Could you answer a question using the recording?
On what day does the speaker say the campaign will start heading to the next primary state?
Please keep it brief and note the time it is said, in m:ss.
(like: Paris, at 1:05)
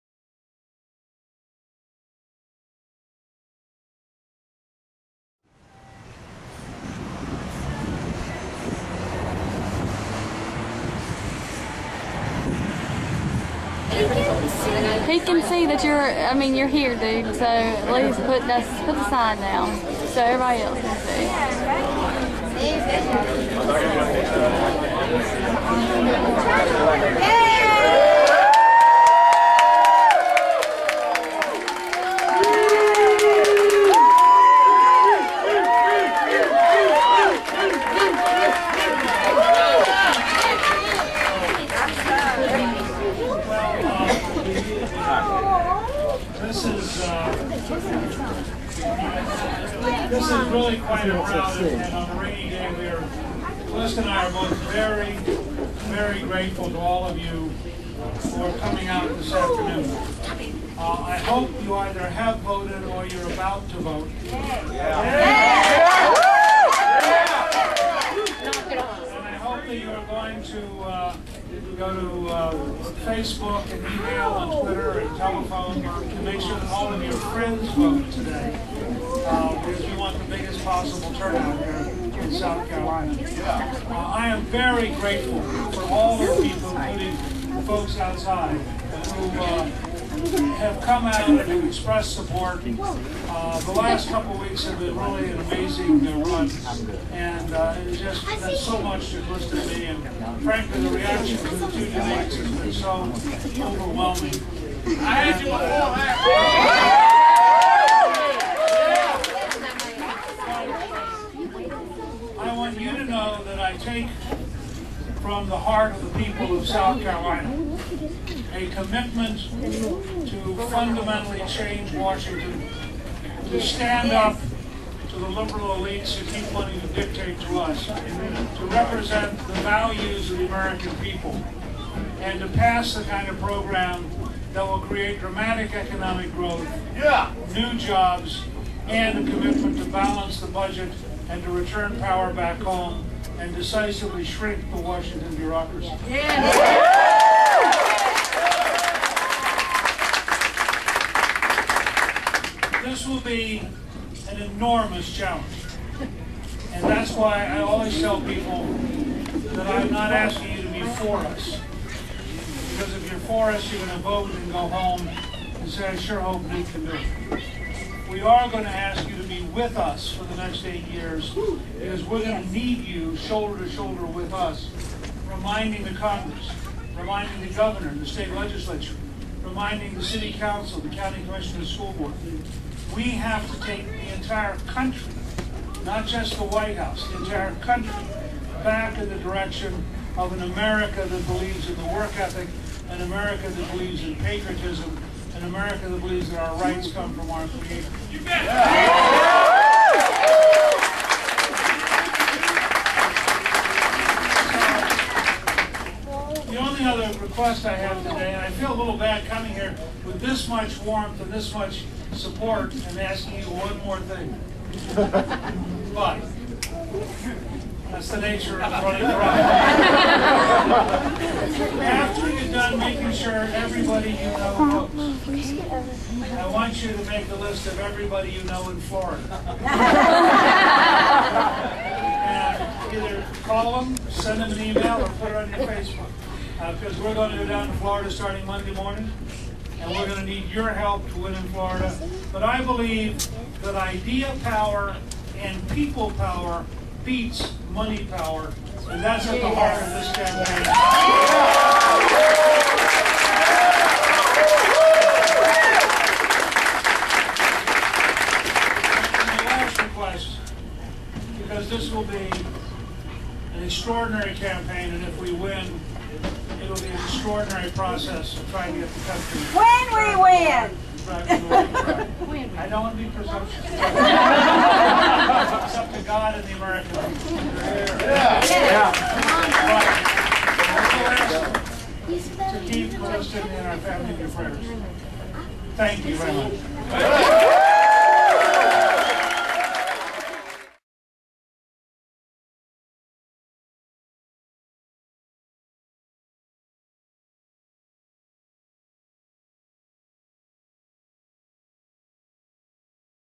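Monday morning, at 3:58.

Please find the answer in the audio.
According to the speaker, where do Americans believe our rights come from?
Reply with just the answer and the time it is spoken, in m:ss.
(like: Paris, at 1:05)
our Creator, at 3:17.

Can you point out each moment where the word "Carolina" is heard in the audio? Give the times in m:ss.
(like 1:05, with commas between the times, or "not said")
1:22, 1:57.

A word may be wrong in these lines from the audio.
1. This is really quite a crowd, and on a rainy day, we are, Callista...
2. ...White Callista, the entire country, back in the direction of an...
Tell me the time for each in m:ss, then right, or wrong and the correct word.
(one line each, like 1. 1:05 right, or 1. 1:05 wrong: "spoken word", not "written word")
1. 0:47 right
2. 3:06 wrong: "House", not "Callista".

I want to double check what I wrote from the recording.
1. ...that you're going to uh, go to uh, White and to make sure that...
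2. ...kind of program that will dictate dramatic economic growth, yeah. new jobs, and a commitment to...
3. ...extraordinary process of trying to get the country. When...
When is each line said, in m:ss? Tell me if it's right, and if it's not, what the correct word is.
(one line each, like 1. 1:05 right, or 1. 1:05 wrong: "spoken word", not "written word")
1. 1:09 wrong: "Facebook", not "White"
2. 2:13 wrong: "create", not "dictate"
3. 4:27 right.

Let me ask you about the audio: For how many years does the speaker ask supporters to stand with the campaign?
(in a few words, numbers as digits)
8.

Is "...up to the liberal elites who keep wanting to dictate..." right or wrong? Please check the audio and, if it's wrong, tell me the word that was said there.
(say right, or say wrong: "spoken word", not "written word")
right.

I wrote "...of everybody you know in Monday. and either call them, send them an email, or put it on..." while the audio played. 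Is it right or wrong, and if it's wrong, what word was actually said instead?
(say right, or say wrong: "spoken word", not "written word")
wrong: "Florida", not "Monday".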